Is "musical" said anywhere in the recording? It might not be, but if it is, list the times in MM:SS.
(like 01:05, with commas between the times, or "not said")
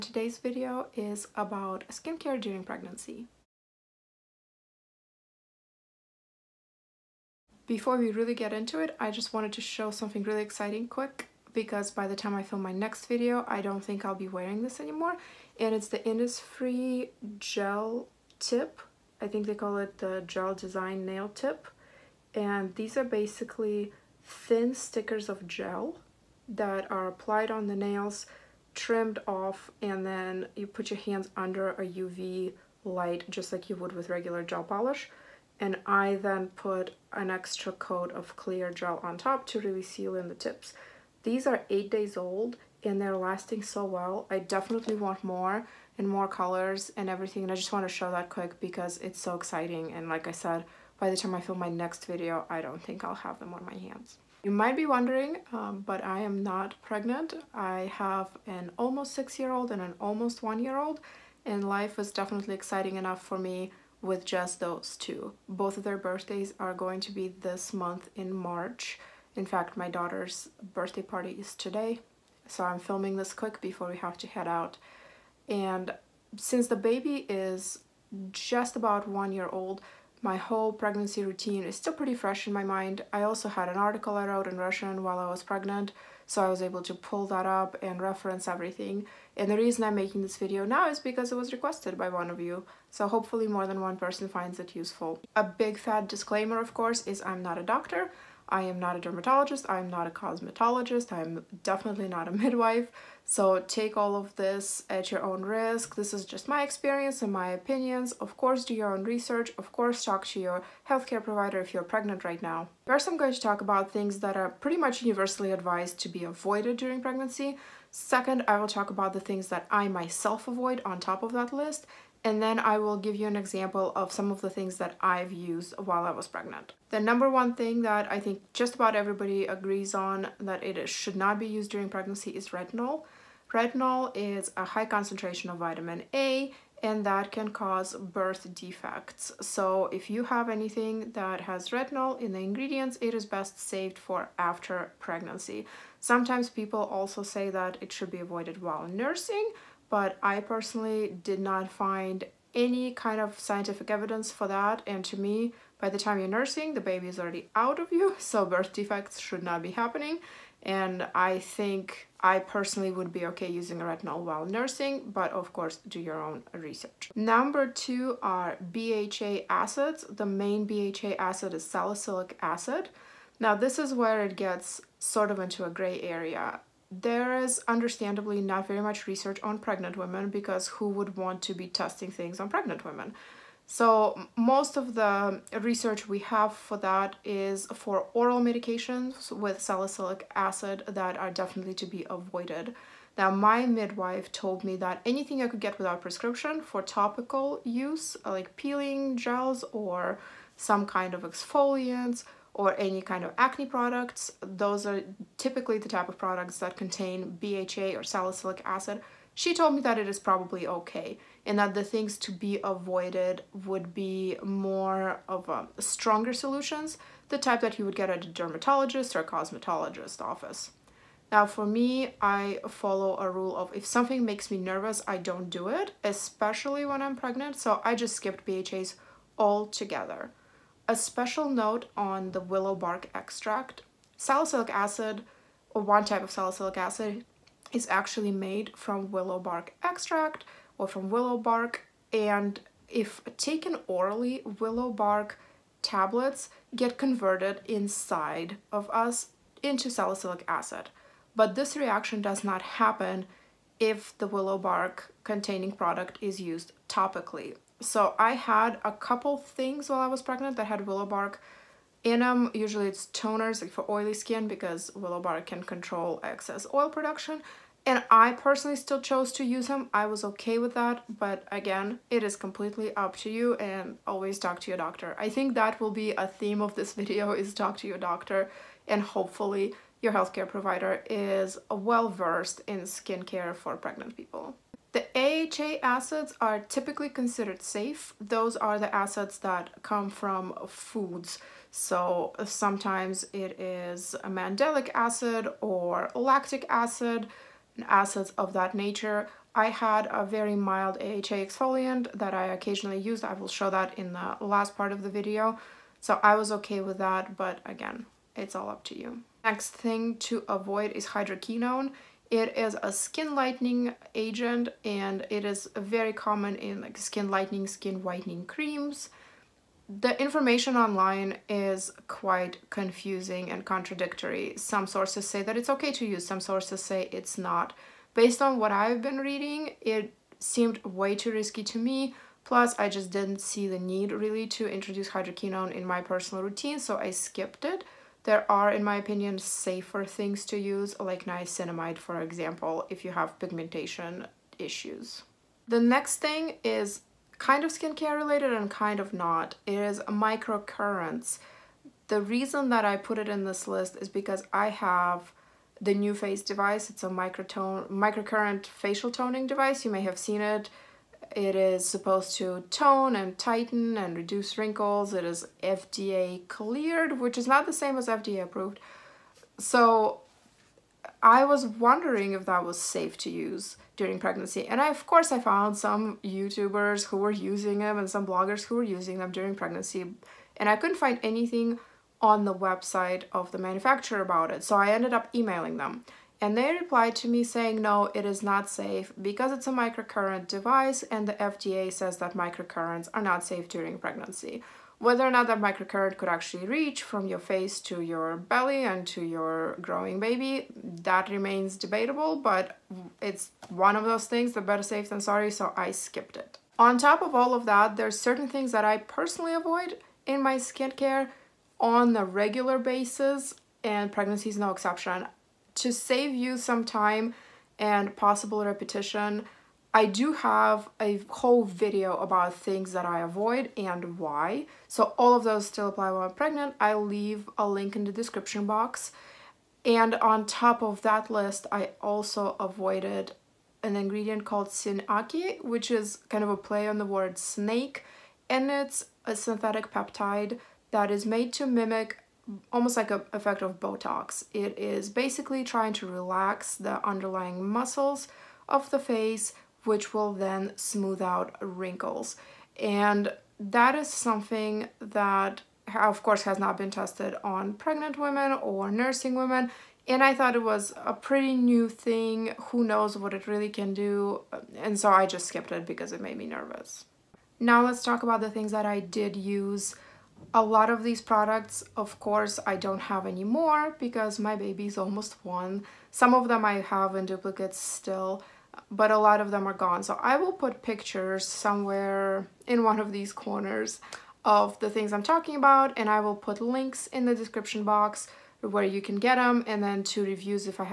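not said.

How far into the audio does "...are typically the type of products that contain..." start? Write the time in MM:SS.
03:24.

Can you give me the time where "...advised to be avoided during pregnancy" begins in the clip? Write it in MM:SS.
01:55.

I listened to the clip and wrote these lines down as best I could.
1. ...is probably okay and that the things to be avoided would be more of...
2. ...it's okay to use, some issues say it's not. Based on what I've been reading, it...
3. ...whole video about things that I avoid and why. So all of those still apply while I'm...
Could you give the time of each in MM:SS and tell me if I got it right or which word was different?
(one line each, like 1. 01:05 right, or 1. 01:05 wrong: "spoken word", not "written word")
1. 03:30 right
2. 05:25 wrong: "sources", not "issues"
3. 07:01 right.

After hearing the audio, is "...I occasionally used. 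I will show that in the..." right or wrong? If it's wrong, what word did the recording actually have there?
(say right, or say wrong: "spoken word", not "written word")
right.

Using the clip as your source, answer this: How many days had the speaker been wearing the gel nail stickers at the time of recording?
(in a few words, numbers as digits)
8.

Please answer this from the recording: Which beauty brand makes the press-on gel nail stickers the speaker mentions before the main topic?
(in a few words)
Innisfree.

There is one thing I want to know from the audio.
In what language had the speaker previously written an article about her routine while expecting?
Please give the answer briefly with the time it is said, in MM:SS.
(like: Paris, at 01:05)
Russian, at 01:24.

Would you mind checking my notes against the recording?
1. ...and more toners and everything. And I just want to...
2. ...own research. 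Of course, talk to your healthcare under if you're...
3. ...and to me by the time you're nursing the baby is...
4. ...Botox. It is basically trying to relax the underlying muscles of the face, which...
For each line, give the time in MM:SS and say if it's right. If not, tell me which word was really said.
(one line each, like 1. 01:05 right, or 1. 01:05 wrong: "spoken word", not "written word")
1. 00:45 wrong: "colors", not "toners"
2. 01:48 wrong: "provider", not "under"
3. 02:34 right
4. 07:23 right.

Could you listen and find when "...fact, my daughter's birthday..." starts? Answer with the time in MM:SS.
01:09.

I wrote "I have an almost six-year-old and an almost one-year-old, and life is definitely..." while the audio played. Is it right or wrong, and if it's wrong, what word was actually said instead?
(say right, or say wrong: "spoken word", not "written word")
right.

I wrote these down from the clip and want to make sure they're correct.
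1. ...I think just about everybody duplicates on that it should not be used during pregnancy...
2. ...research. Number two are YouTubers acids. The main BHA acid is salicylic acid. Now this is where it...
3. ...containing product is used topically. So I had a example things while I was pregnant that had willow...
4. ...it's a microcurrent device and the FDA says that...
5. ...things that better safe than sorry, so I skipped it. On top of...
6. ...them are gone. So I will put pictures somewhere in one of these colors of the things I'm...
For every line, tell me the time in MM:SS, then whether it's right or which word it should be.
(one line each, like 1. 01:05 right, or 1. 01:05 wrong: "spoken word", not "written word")
1. 02:08 wrong: "agrees", not "duplicates"
2. 02:46 wrong: "BHA", not "YouTubers"
3. 04:15 wrong: "couple", not "example"
4. 06:29 right
5. 06:44 right
6. 07:59 wrong: "corners", not "colors".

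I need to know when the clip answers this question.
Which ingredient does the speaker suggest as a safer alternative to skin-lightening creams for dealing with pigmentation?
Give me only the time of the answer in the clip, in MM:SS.
05:41.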